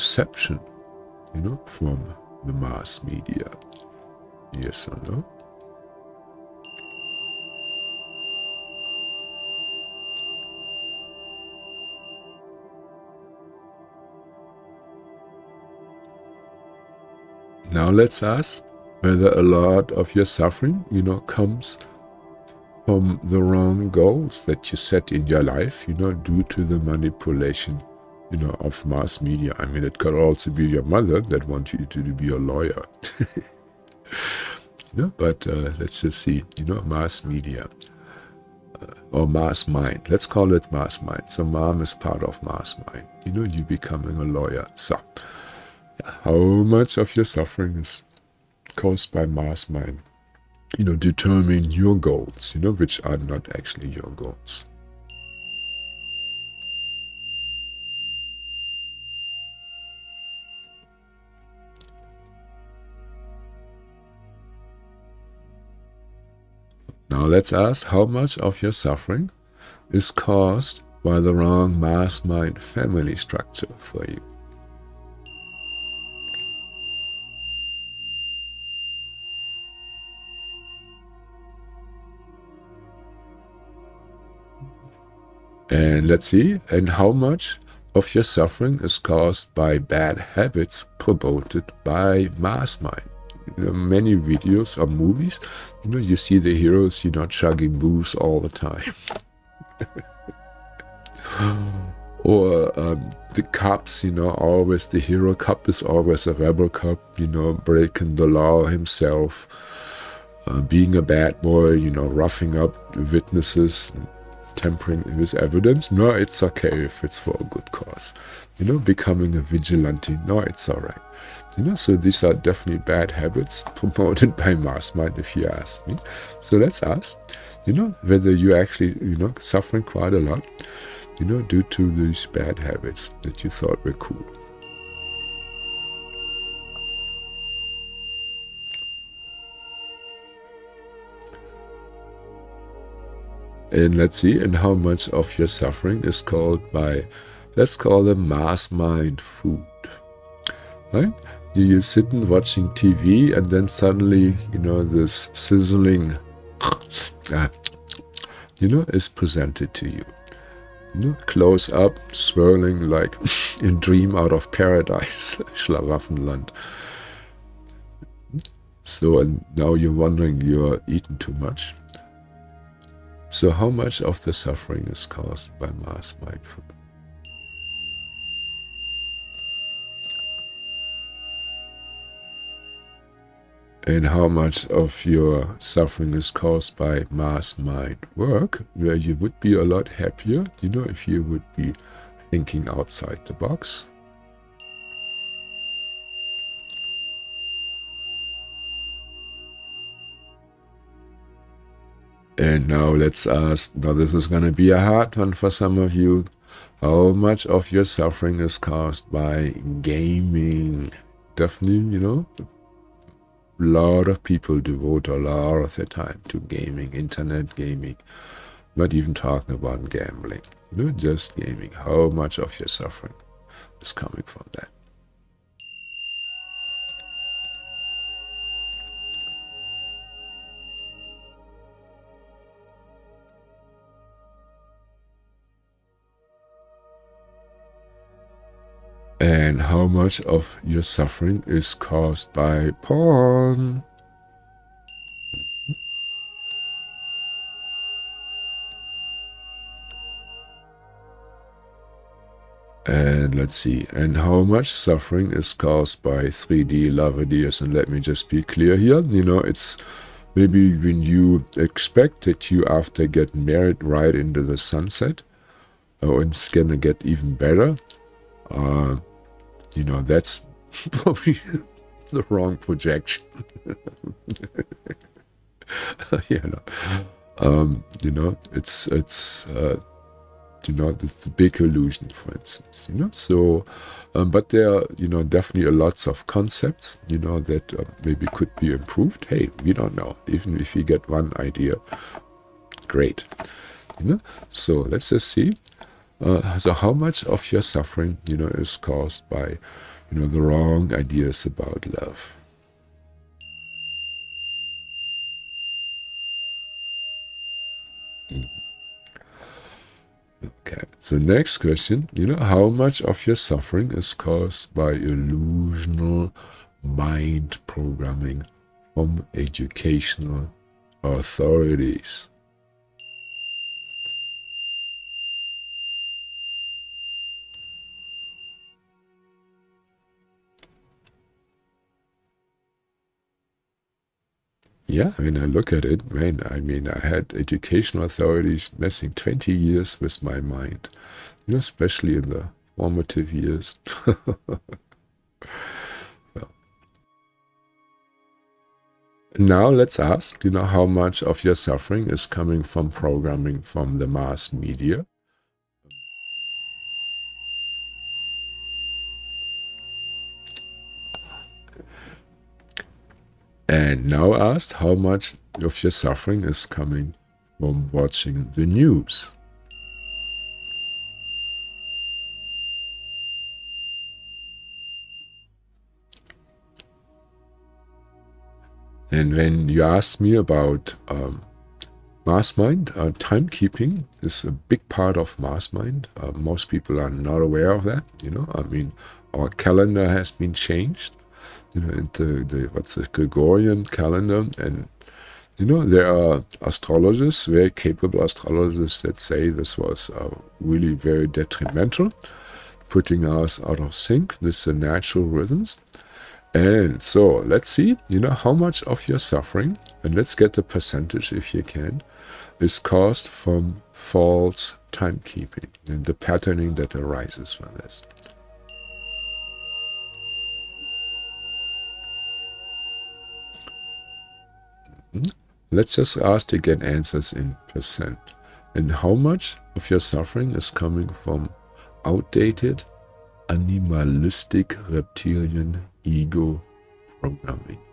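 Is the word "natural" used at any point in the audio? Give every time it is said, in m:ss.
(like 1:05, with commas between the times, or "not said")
6:44.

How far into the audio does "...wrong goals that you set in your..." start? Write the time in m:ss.
0:23.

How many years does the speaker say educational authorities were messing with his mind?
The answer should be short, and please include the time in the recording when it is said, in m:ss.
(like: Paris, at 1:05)
20, at 5:39.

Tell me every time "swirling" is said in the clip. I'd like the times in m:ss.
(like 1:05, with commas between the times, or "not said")
2:42.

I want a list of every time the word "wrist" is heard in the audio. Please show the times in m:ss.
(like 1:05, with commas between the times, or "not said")
not said.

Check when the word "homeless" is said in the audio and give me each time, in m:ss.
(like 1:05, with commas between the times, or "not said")
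not said.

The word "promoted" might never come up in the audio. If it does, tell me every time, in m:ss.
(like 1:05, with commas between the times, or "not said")
1:30, 2:03.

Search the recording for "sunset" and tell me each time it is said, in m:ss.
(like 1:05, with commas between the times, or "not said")
4:24.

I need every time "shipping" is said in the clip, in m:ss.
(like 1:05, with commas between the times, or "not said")
not said.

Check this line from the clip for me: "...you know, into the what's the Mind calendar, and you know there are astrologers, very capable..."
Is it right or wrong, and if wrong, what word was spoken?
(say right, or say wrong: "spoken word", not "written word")
wrong: "Gregorian", not "Mind".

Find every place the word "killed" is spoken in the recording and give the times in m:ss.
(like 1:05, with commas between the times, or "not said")
not said.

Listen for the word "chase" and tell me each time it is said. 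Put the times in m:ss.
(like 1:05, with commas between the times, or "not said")
not said.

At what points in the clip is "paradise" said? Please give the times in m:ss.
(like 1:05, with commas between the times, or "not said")
2:44.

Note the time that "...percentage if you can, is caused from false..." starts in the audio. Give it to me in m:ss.
6:50.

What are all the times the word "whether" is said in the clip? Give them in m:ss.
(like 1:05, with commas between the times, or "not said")
0:18, 2:08.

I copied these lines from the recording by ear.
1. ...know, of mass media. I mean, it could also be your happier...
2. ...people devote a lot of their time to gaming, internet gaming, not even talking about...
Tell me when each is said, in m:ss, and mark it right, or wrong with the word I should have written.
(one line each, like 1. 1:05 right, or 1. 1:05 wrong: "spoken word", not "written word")
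1. 0:28 wrong: "mother", not "happier"
2. 3:34 right.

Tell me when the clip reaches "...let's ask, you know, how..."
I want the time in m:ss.
5:49.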